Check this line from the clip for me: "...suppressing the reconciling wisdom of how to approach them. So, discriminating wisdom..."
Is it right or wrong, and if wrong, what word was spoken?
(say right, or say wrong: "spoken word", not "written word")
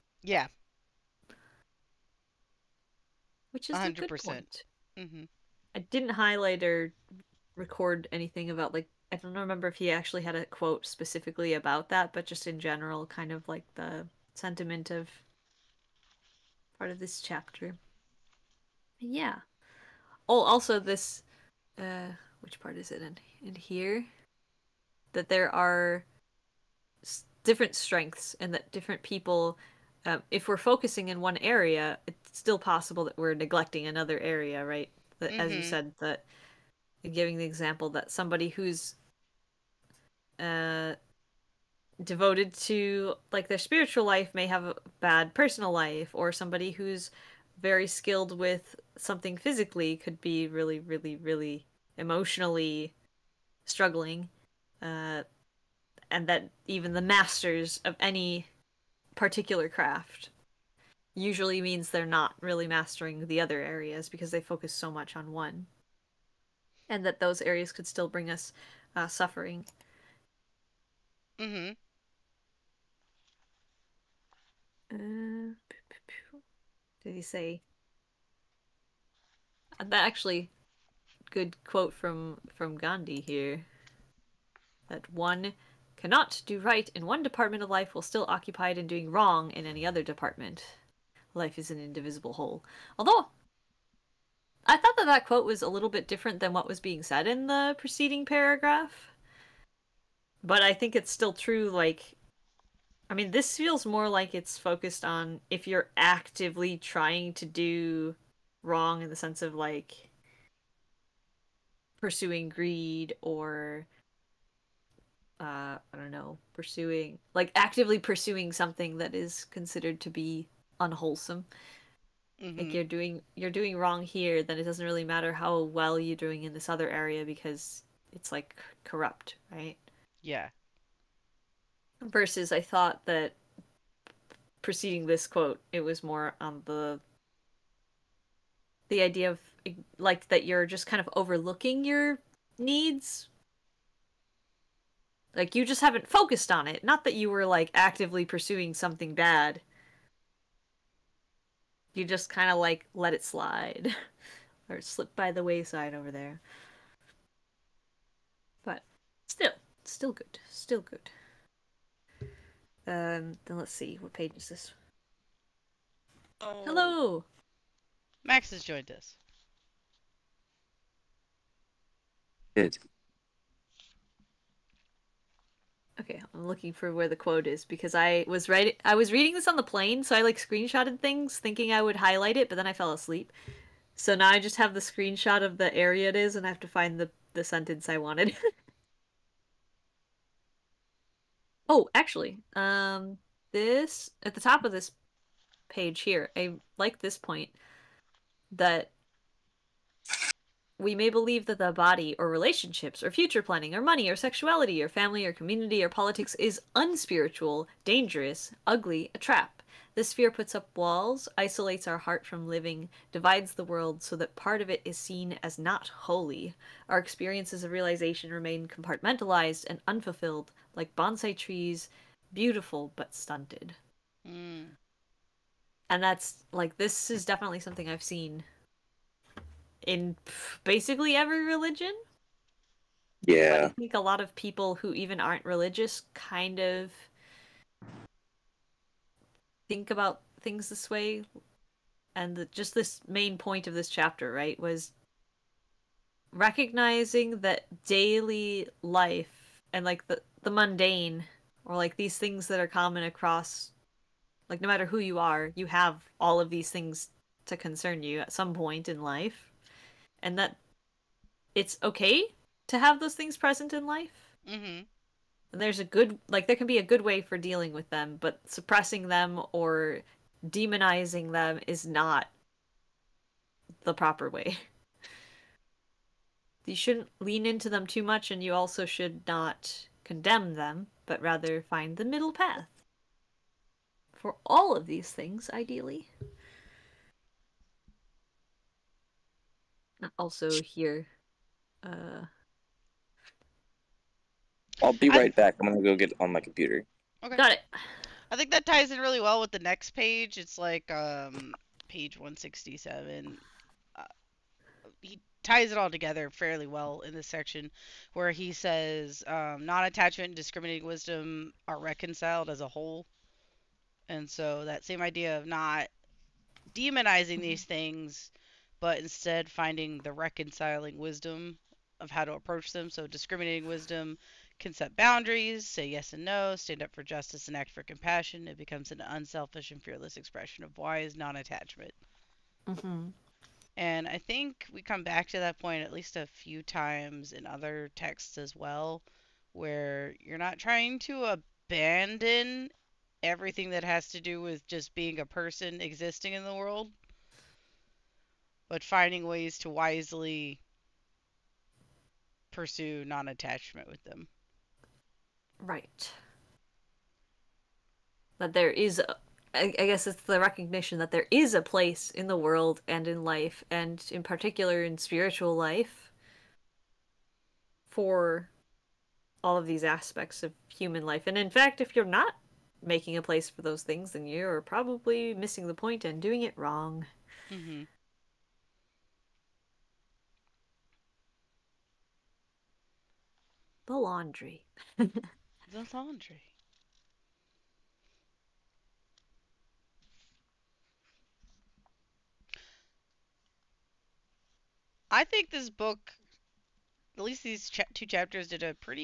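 wrong: "finding", not "suppressing".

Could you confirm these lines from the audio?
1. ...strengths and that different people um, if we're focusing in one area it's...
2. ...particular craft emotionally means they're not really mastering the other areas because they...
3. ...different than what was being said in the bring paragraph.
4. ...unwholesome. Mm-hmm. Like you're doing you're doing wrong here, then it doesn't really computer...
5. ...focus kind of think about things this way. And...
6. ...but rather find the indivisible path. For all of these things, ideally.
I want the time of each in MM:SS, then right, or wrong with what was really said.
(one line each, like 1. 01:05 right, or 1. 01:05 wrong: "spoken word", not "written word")
1. 00:27 right
2. 00:59 wrong: "usually", not "emotionally"
3. 01:36 wrong: "preceding", not "bring"
4. 02:00 wrong: "matter", not "computer"
5. 03:55 wrong: "religious", not "focus"
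6. 04:41 wrong: "middle", not "indivisible".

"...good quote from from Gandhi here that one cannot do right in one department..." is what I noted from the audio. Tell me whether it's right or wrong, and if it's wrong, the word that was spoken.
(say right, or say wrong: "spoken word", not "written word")
right.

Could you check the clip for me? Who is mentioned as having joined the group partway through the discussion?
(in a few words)
Max.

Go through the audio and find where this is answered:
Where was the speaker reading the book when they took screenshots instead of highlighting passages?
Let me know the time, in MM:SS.
02:59.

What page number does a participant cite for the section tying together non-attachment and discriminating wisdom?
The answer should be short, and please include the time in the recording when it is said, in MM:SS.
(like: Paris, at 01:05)
167, at 05:01.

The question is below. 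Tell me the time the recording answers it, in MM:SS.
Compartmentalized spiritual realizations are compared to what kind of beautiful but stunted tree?
03:40.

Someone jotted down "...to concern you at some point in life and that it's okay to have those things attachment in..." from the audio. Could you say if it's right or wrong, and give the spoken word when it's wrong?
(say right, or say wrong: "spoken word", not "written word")
wrong: "present", not "attachment".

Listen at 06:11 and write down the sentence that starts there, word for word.
And in fact, if you're not making a place for those things, then you're probably missing the point and doing it wrong.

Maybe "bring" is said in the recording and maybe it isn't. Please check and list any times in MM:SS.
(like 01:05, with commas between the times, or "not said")
01:08.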